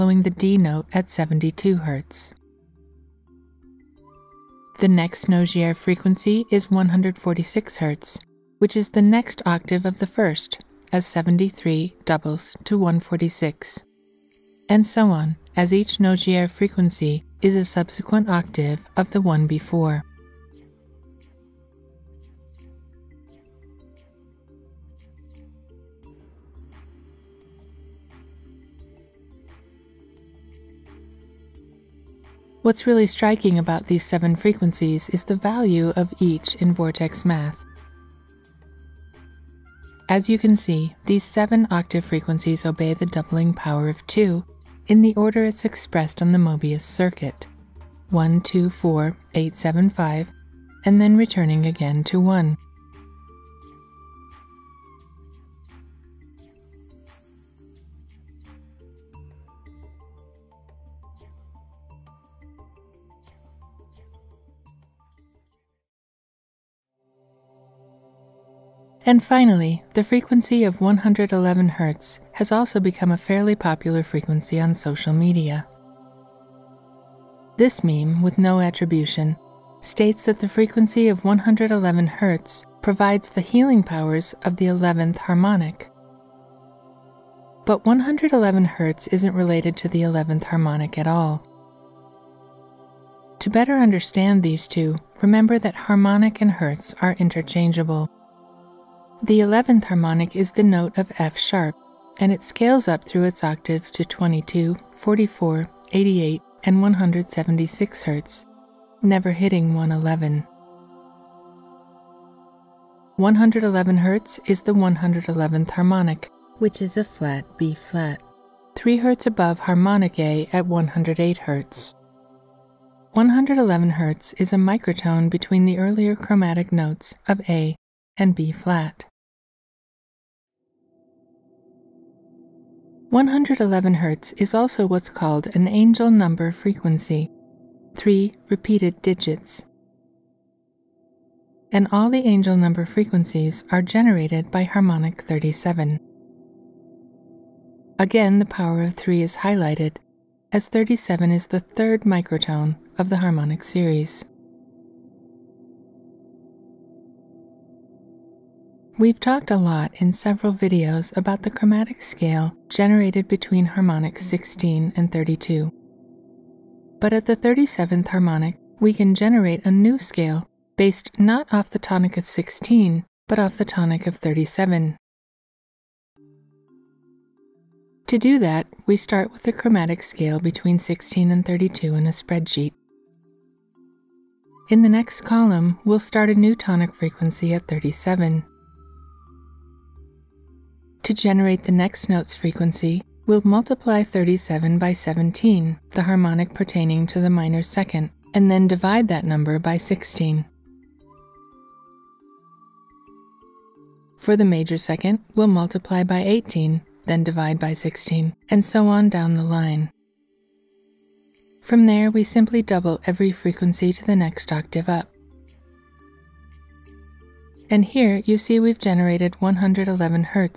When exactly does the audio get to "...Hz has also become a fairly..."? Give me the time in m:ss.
1:11.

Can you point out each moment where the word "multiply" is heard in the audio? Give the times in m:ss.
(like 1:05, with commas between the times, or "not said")
3:13, 3:25.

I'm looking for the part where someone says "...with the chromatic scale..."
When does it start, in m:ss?
2:59.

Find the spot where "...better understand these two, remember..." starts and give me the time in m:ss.
1:33.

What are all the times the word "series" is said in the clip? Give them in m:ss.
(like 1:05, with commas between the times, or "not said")
2:33.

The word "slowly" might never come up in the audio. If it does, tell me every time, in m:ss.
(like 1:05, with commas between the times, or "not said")
not said.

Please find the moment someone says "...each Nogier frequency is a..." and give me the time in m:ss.
0:15.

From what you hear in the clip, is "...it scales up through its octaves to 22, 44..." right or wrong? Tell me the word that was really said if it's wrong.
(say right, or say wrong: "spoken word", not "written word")
right.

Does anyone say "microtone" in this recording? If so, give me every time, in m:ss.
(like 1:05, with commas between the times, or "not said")
2:04, 2:32.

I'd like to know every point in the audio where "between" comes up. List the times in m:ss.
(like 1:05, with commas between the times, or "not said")
2:05, 2:43, 3:00.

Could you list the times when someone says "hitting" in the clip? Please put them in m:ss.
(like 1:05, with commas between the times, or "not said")
1:49.